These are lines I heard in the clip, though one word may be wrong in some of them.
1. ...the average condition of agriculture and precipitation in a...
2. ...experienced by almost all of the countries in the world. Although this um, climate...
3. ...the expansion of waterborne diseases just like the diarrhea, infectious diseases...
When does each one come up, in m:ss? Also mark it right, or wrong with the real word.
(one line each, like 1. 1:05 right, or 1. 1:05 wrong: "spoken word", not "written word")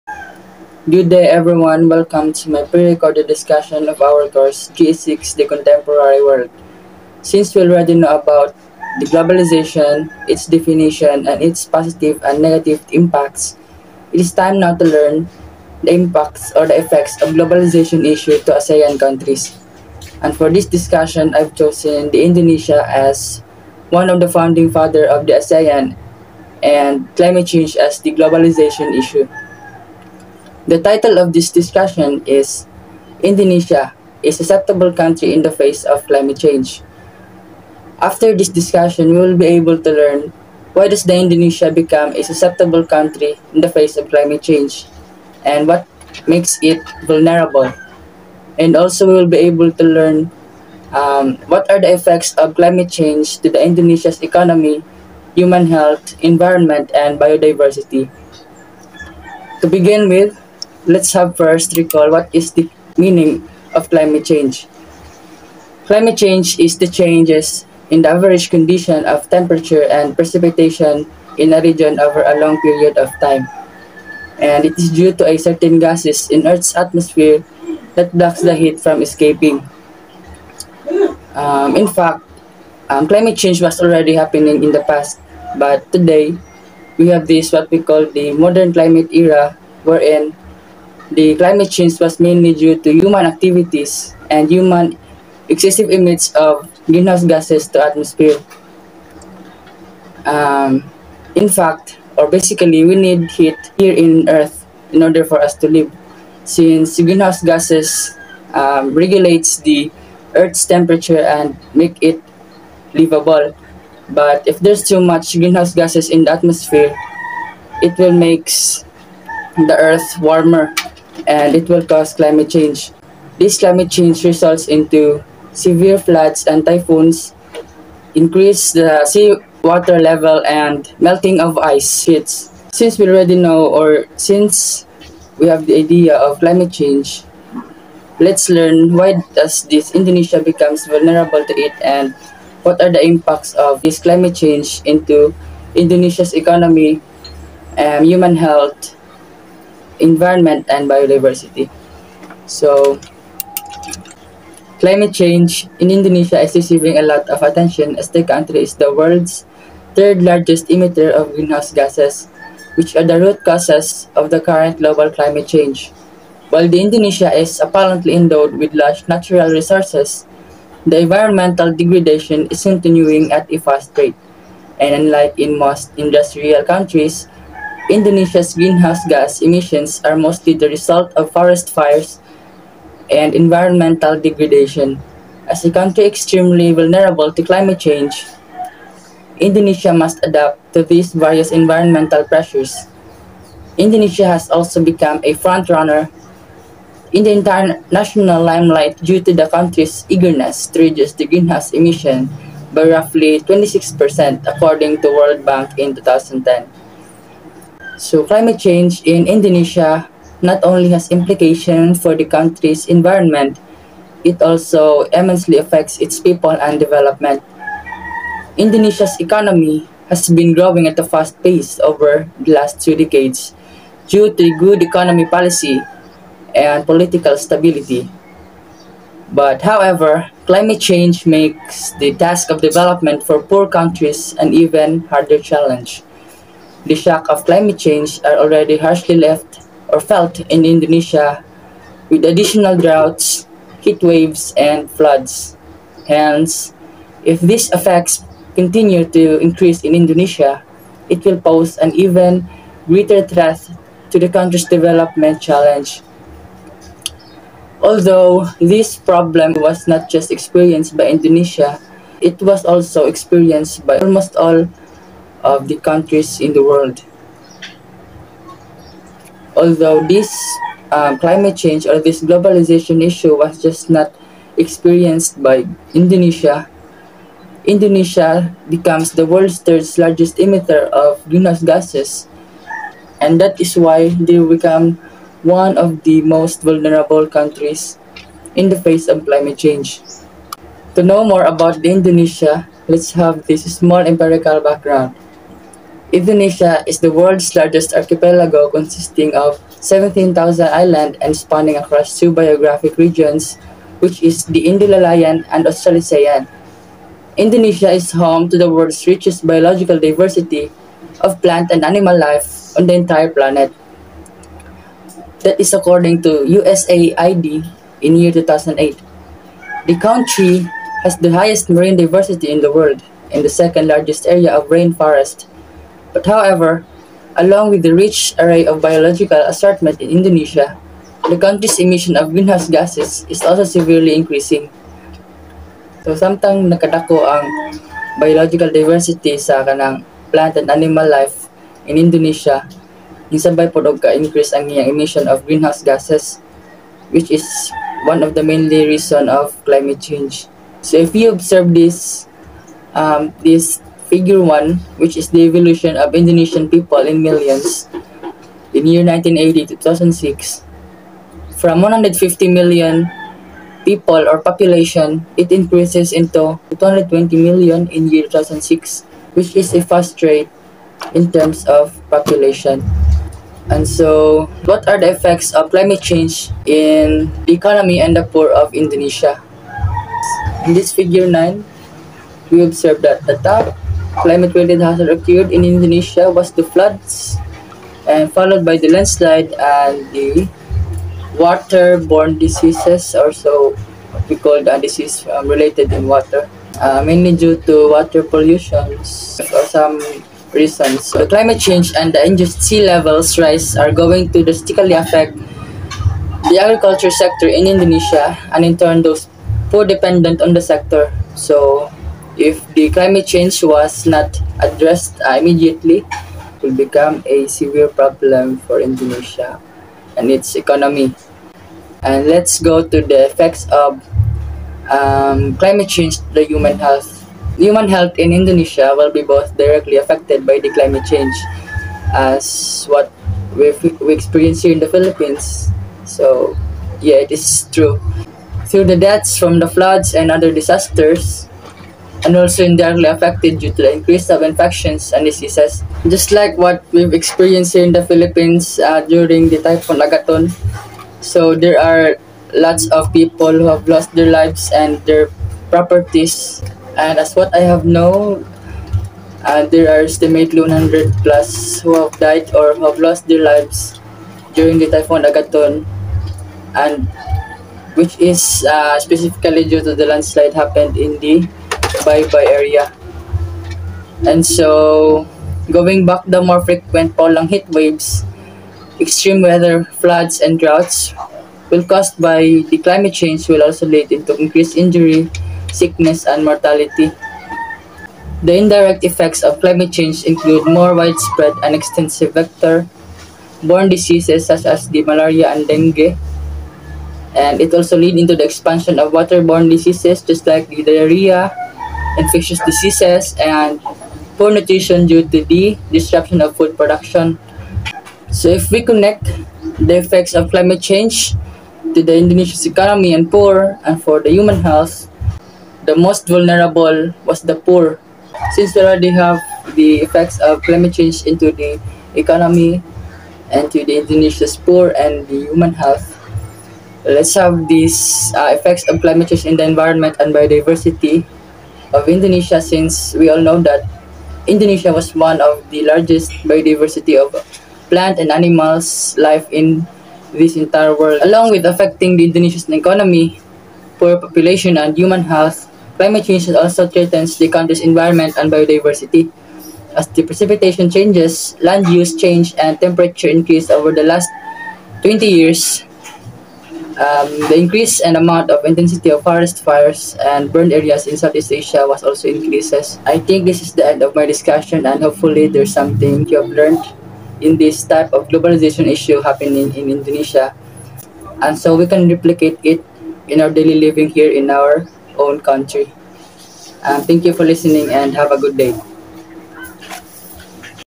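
1. 1:08 wrong: "temperature", not "agriculture"
2. 4:23 right
3. 8:18 right.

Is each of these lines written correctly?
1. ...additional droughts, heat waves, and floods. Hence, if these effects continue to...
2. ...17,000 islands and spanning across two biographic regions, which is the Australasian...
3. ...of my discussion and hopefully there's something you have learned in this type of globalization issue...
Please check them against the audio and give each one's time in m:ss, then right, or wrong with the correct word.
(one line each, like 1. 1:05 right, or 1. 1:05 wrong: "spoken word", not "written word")
1. 4:02 right
2. 4:59 wrong: "Indomalayan", not "Australasian"
3. 9:24 right.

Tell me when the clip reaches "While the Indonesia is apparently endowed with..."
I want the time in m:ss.
2:46.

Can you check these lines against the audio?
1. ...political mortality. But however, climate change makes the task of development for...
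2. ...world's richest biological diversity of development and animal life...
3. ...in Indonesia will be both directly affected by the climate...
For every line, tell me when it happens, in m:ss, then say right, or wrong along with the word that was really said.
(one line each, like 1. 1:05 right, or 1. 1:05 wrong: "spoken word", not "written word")
1. 3:46 wrong: "stability", not "mortality"
2. 5:08 wrong: "plant", not "development"
3. 7:08 right.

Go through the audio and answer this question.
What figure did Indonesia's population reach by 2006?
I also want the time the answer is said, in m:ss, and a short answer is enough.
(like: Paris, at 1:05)
220 million, at 6:06.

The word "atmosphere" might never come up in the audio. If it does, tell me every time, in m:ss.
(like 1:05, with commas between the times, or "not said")
1:16, 1:37, 1:56.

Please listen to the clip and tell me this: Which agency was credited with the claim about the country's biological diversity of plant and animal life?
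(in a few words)
USAID.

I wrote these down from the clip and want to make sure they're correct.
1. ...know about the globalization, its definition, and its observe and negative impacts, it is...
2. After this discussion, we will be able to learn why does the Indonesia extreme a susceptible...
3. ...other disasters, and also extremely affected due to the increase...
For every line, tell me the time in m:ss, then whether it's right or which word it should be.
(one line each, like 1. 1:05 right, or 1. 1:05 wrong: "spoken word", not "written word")
1. 0:07 wrong: "positive", not "observe"
2. 0:37 wrong: "become", not "extreme"
3. 7:20 wrong: "indirectly", not "extremely".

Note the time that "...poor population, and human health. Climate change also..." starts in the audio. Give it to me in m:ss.
9:03.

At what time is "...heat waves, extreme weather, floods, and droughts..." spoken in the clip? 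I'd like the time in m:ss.
7:57.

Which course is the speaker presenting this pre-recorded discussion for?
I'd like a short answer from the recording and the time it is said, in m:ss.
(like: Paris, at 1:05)
G6 The Contemporary World, at 0:04.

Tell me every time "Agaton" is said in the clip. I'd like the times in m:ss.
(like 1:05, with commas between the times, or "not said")
7:29, 7:45.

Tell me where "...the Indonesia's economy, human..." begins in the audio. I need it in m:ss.
0:53.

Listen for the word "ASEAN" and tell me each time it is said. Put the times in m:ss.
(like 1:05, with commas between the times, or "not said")
0:18, 0:25.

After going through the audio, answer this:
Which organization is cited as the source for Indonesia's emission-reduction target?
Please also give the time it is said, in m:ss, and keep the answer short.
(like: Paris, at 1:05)
World Bank, at 3:25.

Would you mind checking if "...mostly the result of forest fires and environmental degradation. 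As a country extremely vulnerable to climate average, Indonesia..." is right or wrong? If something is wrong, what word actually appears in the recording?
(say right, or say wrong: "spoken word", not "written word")
wrong: "change", not "average".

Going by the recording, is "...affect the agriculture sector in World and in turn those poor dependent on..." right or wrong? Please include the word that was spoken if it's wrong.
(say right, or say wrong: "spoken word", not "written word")
wrong: "Indonesia", not "World".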